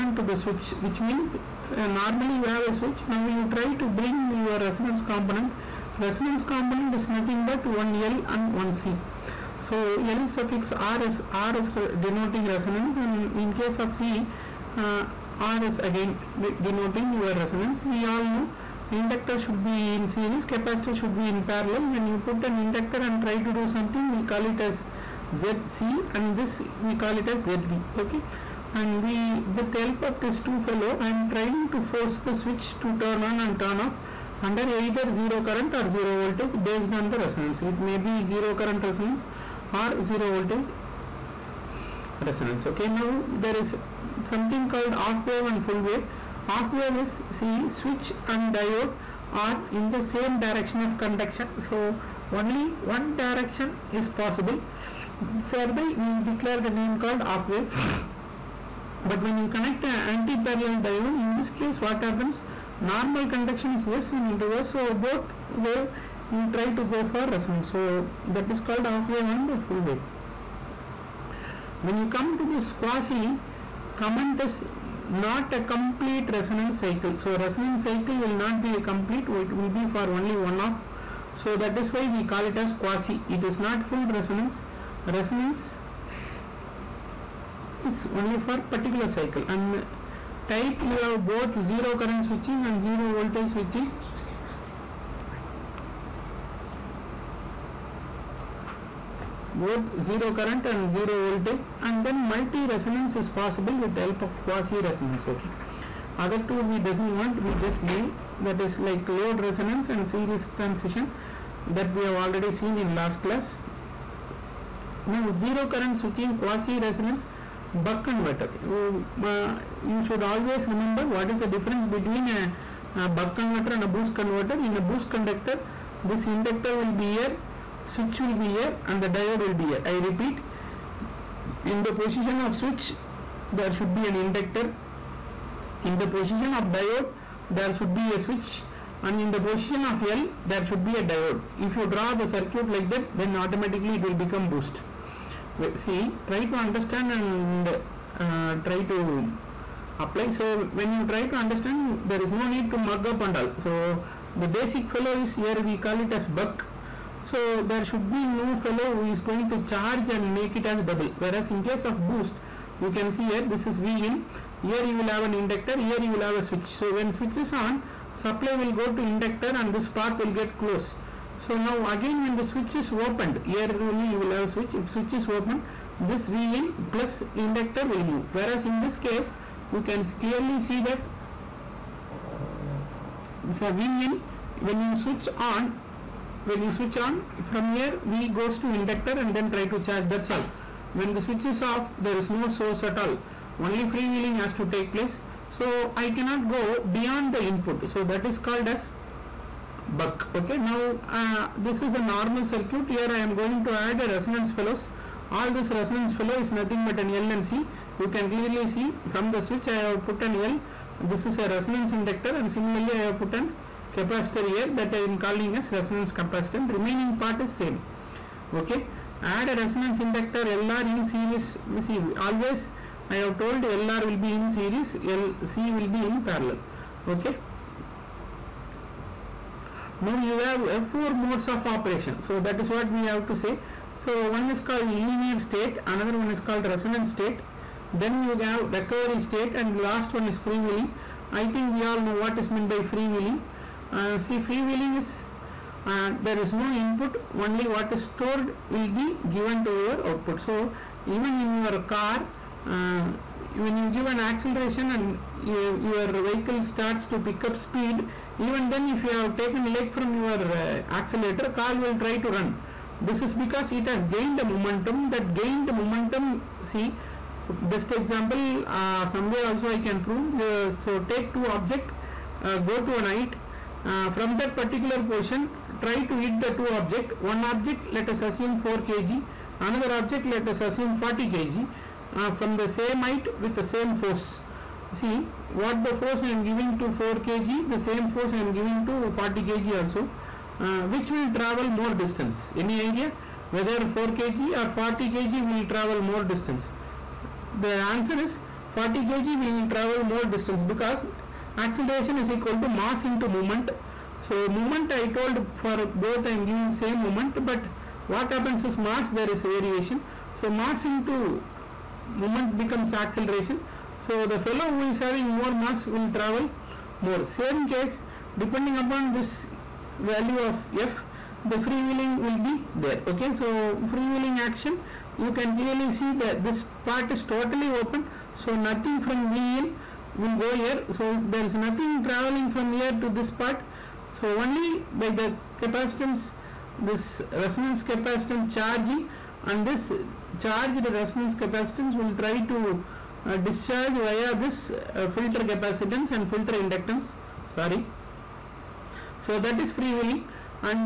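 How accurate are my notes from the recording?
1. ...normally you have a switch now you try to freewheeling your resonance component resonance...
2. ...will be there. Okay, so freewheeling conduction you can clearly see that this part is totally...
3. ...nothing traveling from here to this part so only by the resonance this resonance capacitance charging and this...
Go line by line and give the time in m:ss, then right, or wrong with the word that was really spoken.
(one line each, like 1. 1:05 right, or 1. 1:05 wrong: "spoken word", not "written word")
1. 0:01 wrong: "bring", not "freewheeling"
2. 5:22 wrong: "action", not "conduction"
3. 5:31 wrong: "capacitance", not "resonance".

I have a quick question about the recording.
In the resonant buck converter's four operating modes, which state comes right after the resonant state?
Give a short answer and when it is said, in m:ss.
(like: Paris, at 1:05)
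Recovery state, at 3:58.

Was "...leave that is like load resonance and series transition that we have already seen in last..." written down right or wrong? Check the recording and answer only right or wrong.
right.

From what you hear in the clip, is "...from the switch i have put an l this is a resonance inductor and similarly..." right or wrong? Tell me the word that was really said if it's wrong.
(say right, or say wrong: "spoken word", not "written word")
right.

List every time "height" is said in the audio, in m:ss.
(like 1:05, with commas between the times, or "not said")
4:33, 4:43.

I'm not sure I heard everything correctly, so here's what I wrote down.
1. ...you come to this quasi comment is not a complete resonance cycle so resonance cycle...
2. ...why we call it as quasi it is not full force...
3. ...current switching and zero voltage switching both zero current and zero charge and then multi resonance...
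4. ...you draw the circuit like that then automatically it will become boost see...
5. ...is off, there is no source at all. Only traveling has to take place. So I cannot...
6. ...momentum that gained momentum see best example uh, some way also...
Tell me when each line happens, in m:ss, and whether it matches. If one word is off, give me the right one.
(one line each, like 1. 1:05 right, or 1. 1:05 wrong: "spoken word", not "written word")
1. 1:11 right
2. 1:21 wrong: "resonance", not "force"
3. 1:31 wrong: "voltage", not "charge"
4. 2:21 right
5. 3:11 wrong: "freewheeling", not "traveling"
6. 4:24 right.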